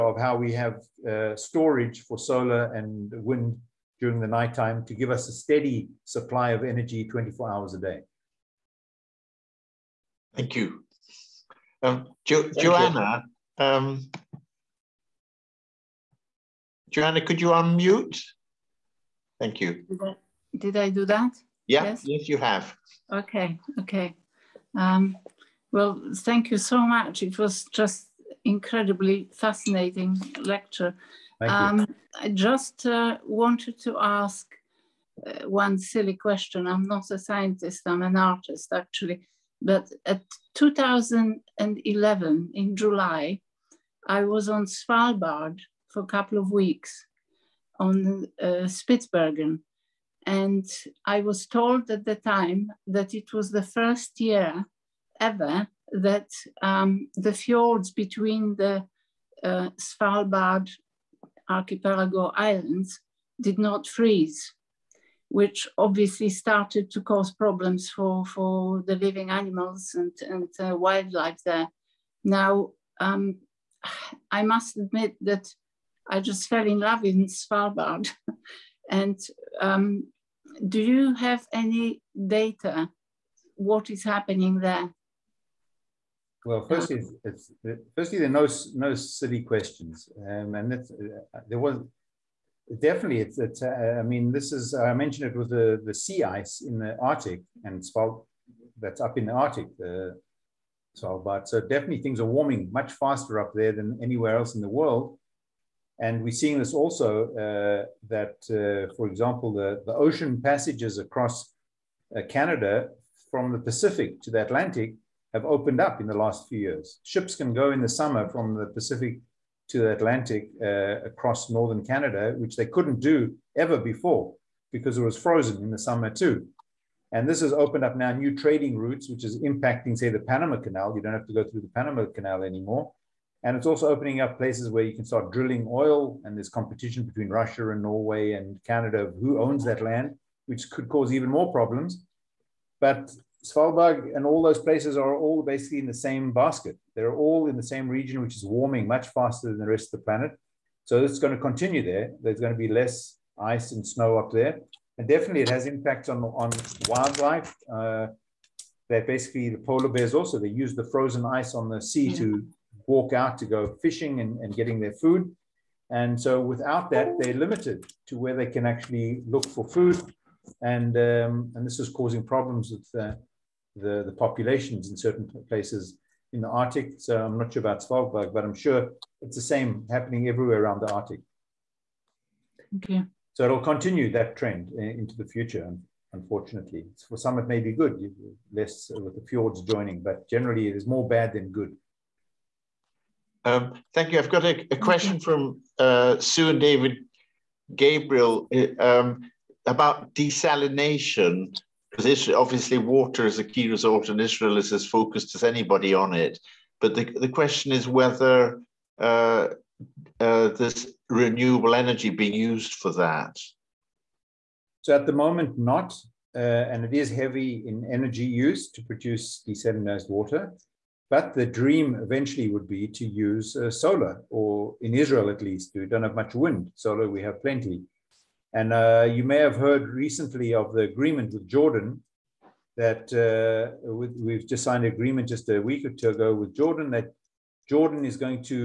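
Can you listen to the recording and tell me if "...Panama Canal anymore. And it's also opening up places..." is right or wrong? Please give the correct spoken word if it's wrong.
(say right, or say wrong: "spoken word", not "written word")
right.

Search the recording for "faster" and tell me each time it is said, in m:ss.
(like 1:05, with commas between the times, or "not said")
1:42, 2:29.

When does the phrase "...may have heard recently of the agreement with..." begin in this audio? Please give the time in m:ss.
3:49.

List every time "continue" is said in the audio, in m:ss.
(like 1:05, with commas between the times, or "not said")
2:31, 3:03.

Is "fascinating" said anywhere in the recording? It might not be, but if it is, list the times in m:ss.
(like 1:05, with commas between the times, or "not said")
0:29.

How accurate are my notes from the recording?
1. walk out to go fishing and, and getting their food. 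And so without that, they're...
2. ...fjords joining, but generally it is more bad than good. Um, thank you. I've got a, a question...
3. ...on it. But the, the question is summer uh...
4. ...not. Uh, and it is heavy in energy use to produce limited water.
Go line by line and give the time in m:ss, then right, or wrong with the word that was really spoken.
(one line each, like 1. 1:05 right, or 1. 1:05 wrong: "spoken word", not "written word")
1. 2:42 right
2. 3:09 right
3. 3:25 wrong: "whether", not "summer"
4. 3:35 wrong: "desalinized", not "limited".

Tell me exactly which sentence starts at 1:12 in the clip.
Now, um, I must admit that I just fell in love in Svalbard.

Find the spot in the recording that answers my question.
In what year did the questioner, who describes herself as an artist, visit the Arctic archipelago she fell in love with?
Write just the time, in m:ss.
0:40.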